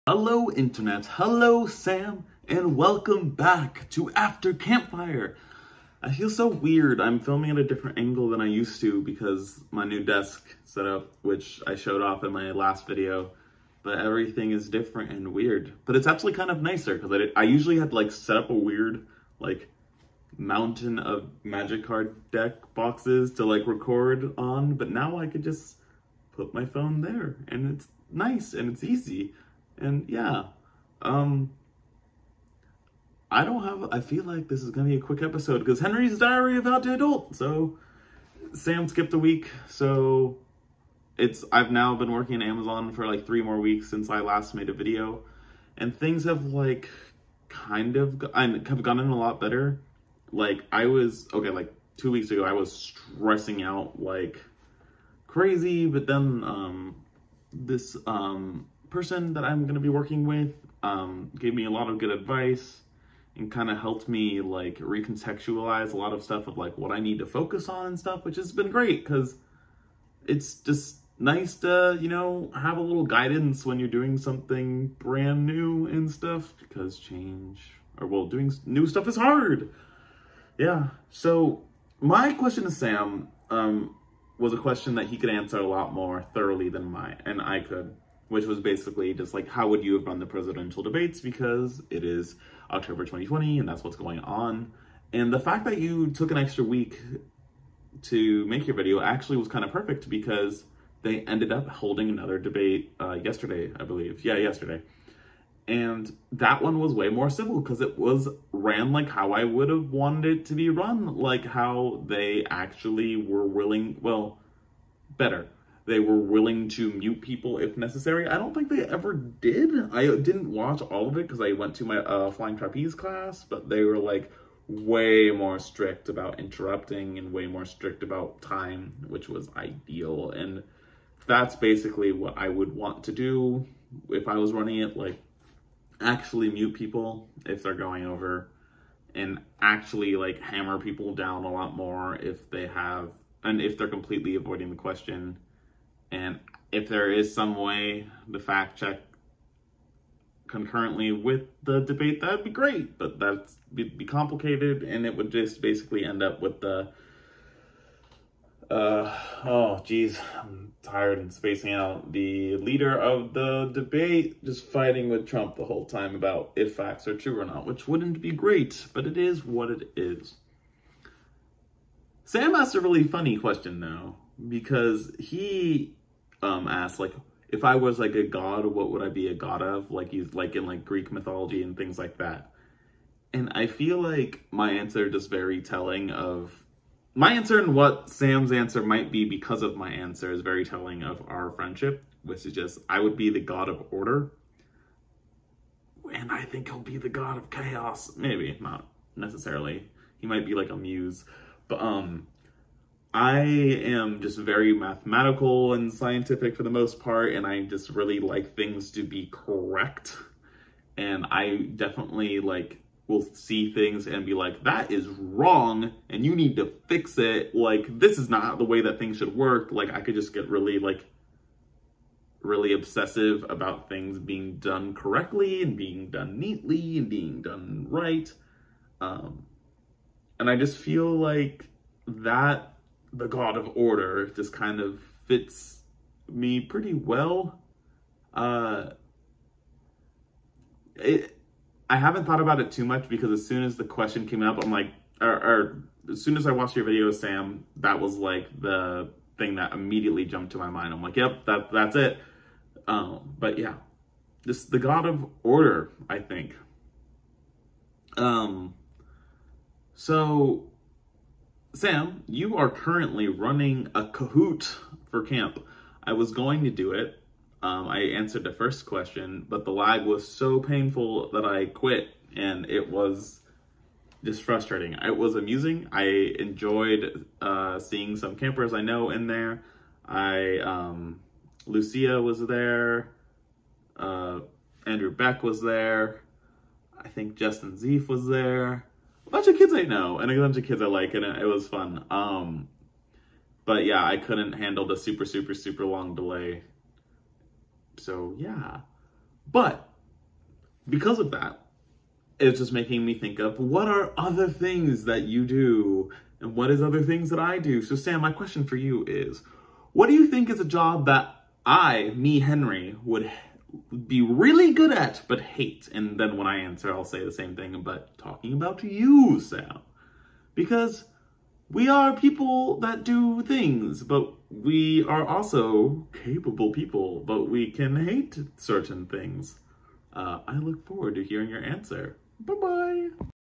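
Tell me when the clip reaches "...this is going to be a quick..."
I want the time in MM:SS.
00:34.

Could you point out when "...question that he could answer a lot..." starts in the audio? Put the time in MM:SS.
01:24.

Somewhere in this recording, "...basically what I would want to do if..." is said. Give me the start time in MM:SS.
02:11.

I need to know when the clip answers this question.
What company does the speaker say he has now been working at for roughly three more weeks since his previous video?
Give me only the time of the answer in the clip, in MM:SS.
00:42.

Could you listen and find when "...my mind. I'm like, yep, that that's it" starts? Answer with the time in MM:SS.
04:10.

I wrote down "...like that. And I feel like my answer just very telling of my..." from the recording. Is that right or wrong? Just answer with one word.
right.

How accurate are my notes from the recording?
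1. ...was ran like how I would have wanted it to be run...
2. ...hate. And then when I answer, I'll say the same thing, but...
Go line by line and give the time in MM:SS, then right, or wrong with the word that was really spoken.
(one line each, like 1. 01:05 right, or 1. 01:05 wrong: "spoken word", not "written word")
1. 01:47 right
2. 05:15 right.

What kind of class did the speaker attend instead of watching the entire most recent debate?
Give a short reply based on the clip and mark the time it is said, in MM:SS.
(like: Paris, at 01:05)
flying trapeze, at 02:02.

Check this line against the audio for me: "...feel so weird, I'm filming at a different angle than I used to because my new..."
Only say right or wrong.
right.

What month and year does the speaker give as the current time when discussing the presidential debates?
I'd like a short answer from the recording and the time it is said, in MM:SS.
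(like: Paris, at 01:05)
October 2020, at 01:32.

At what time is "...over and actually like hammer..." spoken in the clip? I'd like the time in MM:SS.
02:18.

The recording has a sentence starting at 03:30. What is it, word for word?
And I definitely like will see things and be like, that is wrong, and you need to fix it.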